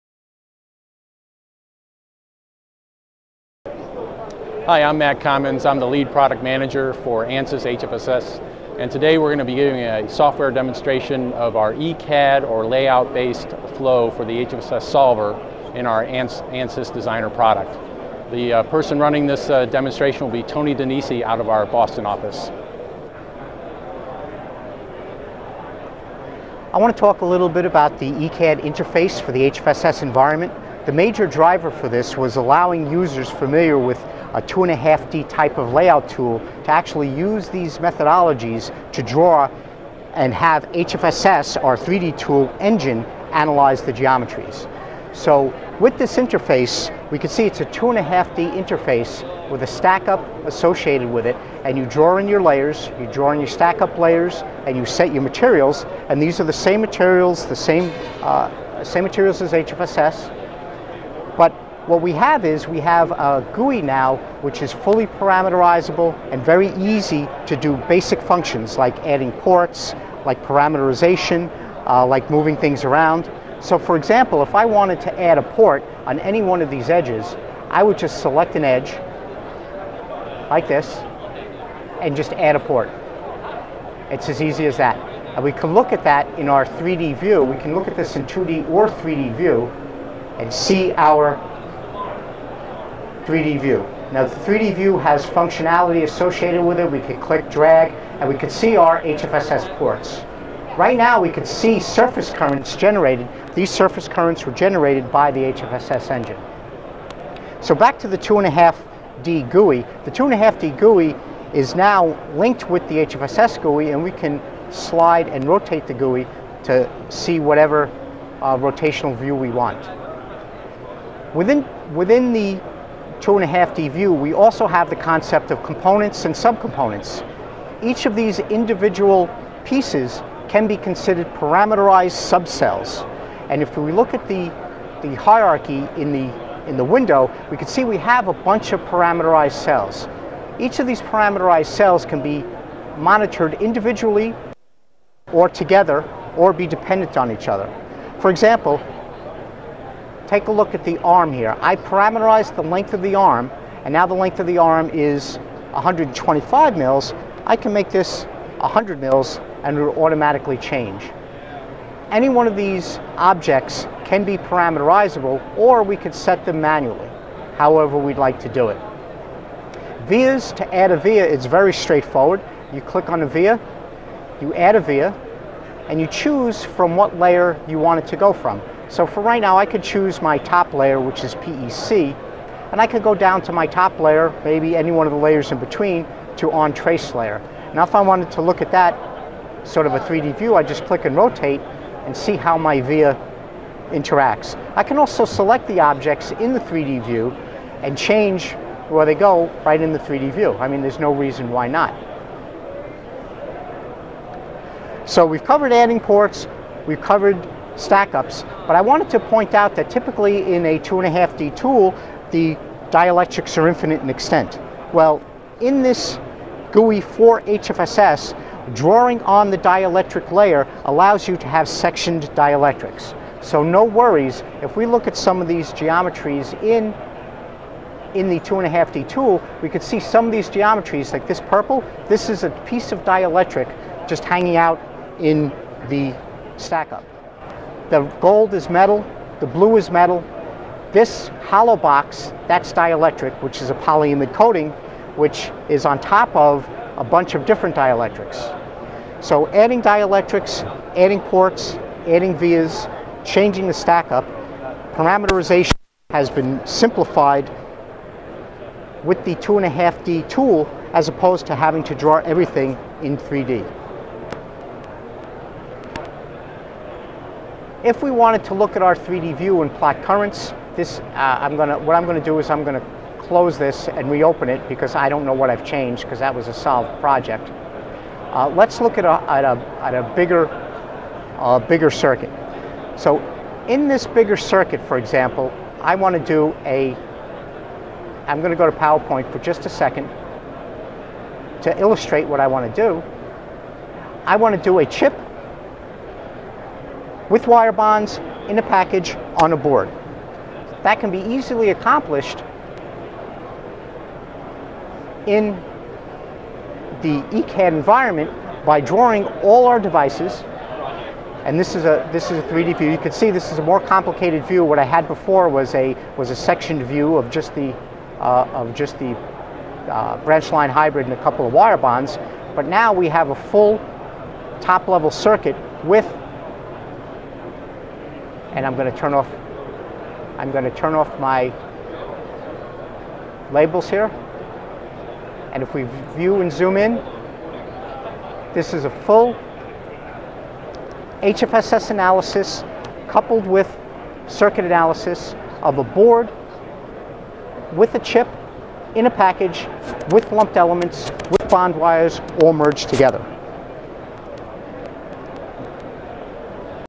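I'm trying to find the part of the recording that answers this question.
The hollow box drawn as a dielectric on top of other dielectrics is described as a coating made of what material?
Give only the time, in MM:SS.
04:03.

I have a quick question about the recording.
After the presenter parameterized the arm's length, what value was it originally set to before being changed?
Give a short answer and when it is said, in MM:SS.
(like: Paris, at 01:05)
125 mils, at 02:35.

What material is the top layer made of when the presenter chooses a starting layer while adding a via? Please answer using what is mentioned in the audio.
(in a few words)
PEC.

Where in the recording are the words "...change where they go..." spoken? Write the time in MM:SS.
03:17.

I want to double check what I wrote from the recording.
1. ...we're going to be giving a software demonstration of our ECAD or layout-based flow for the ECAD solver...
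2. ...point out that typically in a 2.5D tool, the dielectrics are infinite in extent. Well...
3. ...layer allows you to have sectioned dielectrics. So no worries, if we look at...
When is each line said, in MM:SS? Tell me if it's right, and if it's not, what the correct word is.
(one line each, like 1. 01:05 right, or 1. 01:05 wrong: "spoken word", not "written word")
1. 00:09 wrong: "HFSS", not "ECAD"
2. 03:29 right
3. 03:40 right.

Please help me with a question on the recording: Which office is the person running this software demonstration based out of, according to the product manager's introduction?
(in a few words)
Boston.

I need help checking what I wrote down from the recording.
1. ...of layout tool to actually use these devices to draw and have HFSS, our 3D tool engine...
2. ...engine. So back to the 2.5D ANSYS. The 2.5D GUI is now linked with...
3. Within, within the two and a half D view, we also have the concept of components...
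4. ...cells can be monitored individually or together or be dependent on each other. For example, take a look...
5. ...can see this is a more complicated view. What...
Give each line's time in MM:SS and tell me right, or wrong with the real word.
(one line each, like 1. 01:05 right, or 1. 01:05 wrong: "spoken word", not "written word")
1. 00:35 wrong: "methodologies", not "devices"
2. 01:46 wrong: "GUI", not "ANSYS"
3. 02:01 right
4. 02:21 right
5. 05:12 right.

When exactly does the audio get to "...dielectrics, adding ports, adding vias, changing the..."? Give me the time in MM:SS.
04:09.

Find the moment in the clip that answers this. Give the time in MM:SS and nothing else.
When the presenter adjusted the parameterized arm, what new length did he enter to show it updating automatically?
02:38.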